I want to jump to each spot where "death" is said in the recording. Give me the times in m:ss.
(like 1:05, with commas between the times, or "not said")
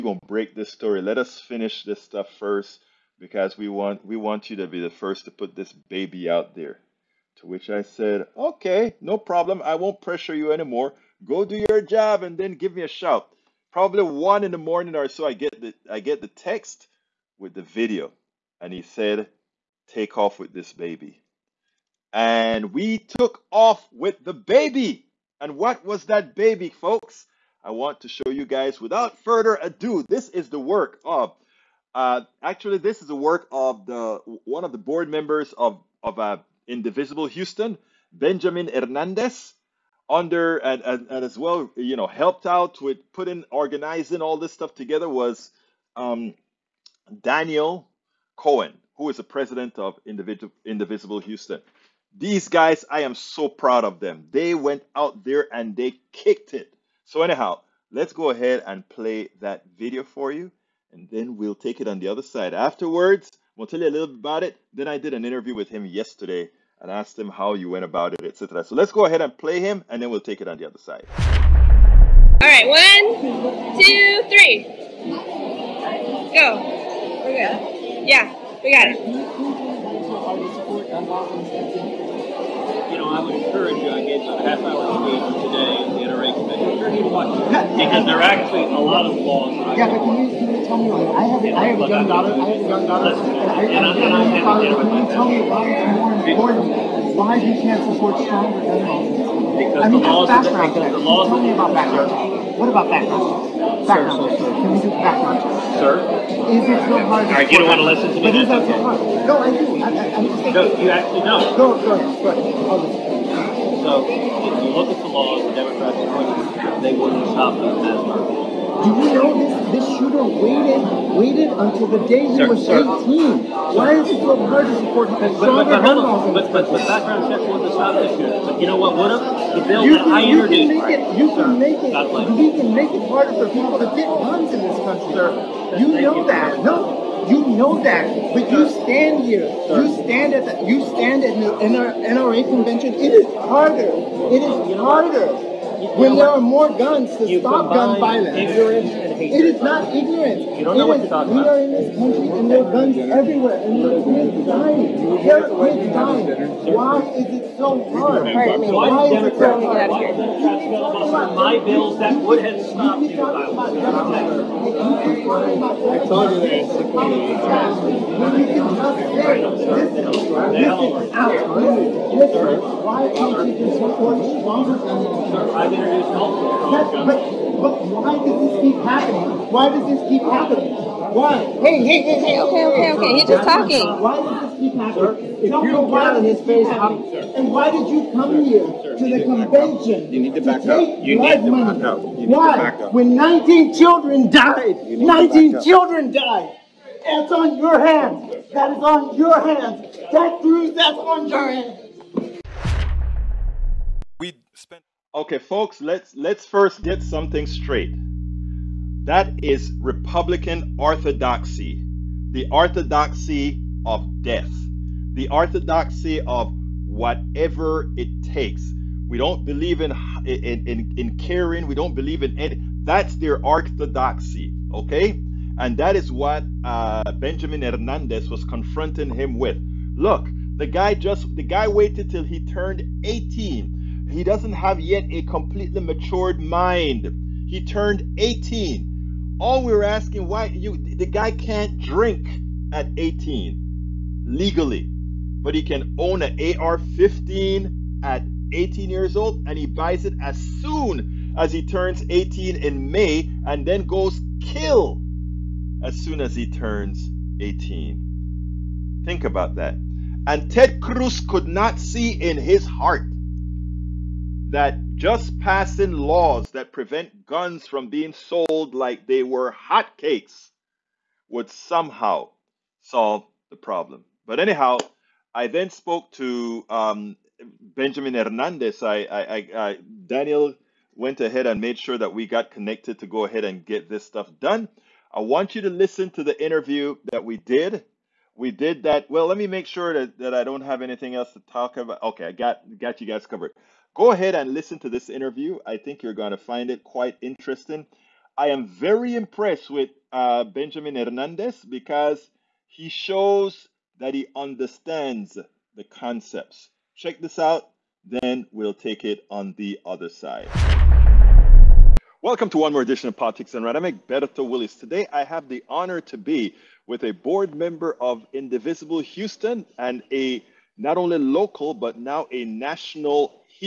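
3:34.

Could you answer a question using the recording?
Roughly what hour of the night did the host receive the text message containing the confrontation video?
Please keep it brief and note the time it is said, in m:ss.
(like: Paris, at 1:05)
1 in the morning, at 0:14.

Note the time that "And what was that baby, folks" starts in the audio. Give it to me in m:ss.
0:25.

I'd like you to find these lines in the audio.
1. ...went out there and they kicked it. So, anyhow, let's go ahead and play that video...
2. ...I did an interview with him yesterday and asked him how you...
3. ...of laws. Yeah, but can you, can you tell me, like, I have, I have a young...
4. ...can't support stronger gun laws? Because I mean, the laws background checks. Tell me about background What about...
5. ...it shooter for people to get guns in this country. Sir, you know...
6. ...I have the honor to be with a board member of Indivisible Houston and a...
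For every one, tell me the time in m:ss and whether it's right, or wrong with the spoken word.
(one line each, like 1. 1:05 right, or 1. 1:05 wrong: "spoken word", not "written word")
1. 0:54 right
2. 1:04 right
3. 1:29 right
4. 1:37 right
5. 2:12 wrong: "harder", not "shooter"
6. 5:15 right.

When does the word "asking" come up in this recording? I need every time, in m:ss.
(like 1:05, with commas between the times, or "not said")
3:59.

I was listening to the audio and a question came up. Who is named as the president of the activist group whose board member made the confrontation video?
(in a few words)
Daniel Cohen.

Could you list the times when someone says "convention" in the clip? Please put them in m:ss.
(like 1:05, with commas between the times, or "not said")
2:22, 3:09.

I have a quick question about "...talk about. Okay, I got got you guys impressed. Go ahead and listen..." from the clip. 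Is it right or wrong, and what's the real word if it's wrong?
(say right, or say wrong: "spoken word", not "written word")
wrong: "covered", not "impressed".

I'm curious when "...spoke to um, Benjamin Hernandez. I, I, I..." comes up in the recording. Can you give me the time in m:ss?
4:35.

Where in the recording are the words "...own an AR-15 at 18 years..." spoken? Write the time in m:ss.
4:05.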